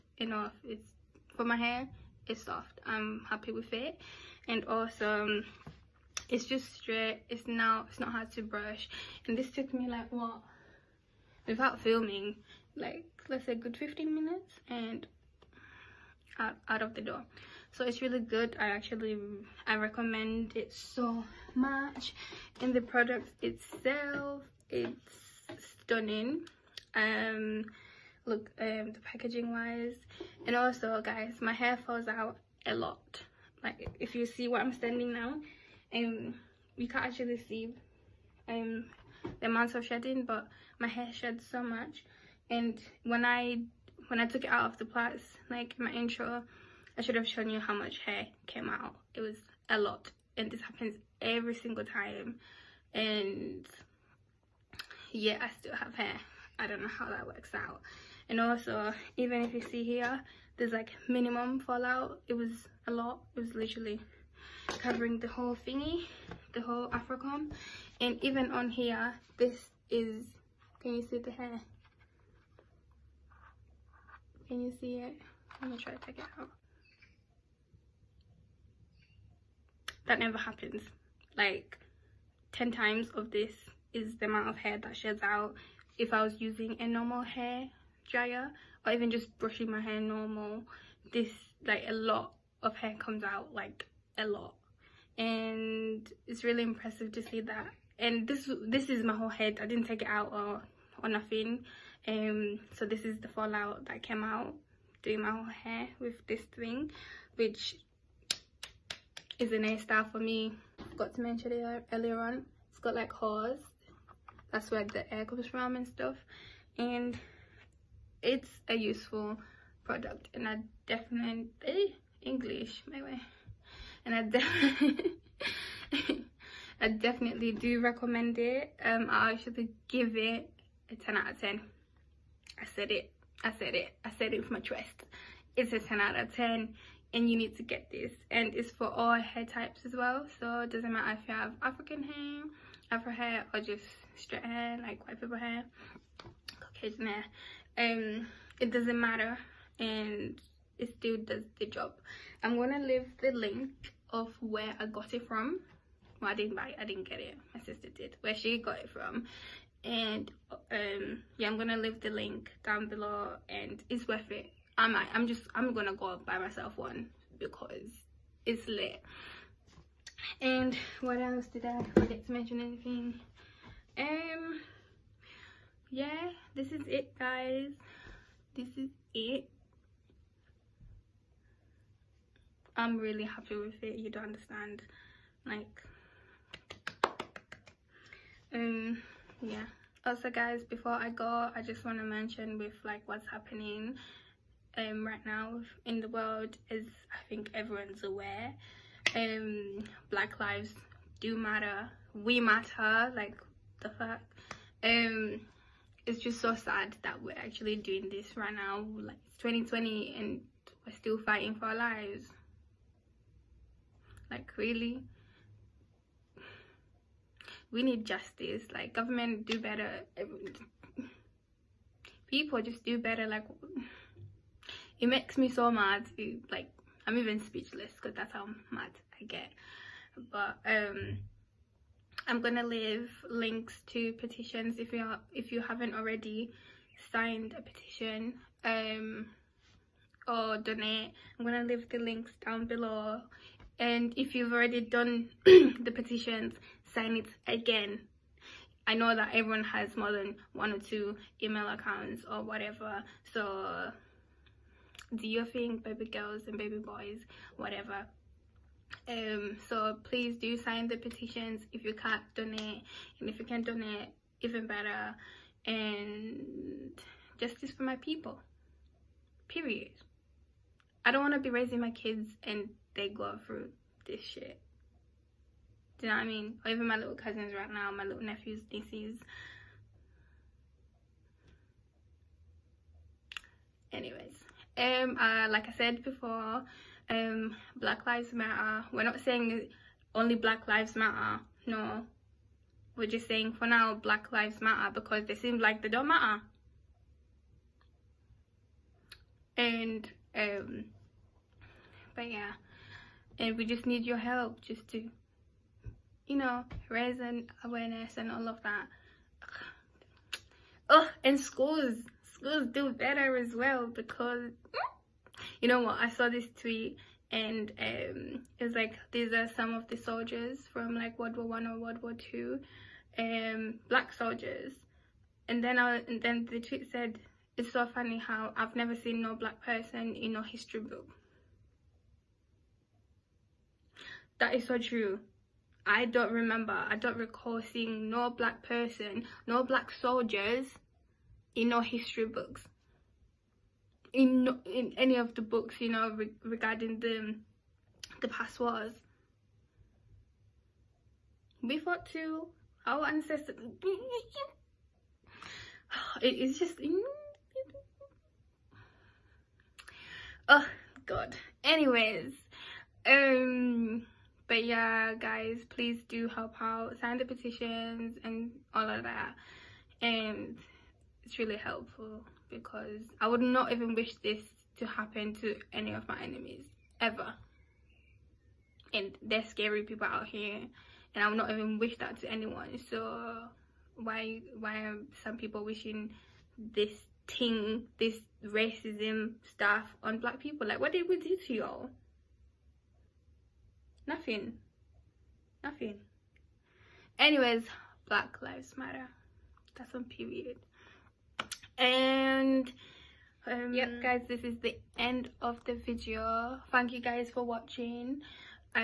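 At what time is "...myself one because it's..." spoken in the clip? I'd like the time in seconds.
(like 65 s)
166 s.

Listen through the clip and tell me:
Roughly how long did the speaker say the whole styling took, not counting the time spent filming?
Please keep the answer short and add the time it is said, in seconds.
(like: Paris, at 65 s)
15 minutes, at 13 s.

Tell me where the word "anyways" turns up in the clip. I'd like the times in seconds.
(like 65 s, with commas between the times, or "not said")
283 s, 361 s, 397 s.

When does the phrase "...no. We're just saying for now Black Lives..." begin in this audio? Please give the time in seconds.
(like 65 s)
291 s.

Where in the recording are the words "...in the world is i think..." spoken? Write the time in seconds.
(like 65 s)
195 s.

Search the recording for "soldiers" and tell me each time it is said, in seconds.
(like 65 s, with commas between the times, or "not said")
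319 s, 324 s, 339 s.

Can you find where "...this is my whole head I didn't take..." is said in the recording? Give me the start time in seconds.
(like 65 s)
98 s.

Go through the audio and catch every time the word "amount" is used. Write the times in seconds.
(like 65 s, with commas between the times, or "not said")
39 s, 84 s.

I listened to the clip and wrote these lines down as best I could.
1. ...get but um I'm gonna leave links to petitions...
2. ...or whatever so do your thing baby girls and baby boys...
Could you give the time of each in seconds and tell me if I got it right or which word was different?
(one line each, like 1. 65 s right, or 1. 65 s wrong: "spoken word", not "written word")
1. 229 s right
2. 252 s right.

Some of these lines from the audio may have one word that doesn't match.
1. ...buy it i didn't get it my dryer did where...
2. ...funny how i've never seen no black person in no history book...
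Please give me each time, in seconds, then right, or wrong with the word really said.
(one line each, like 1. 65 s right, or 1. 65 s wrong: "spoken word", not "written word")
1. 156 s wrong: "sister", not "dryer"
2. 327 s right.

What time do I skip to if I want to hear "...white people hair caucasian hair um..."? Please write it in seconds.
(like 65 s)
145 s.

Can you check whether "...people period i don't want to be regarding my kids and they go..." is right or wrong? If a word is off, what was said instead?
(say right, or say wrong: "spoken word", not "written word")
wrong: "raising", not "regarding".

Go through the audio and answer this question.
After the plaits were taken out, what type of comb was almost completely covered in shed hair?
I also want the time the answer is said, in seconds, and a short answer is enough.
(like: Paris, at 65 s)
Afro comb, at 66 s.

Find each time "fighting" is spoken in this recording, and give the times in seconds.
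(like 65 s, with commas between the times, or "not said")
211 s.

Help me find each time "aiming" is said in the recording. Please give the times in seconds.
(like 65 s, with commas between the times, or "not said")
not said.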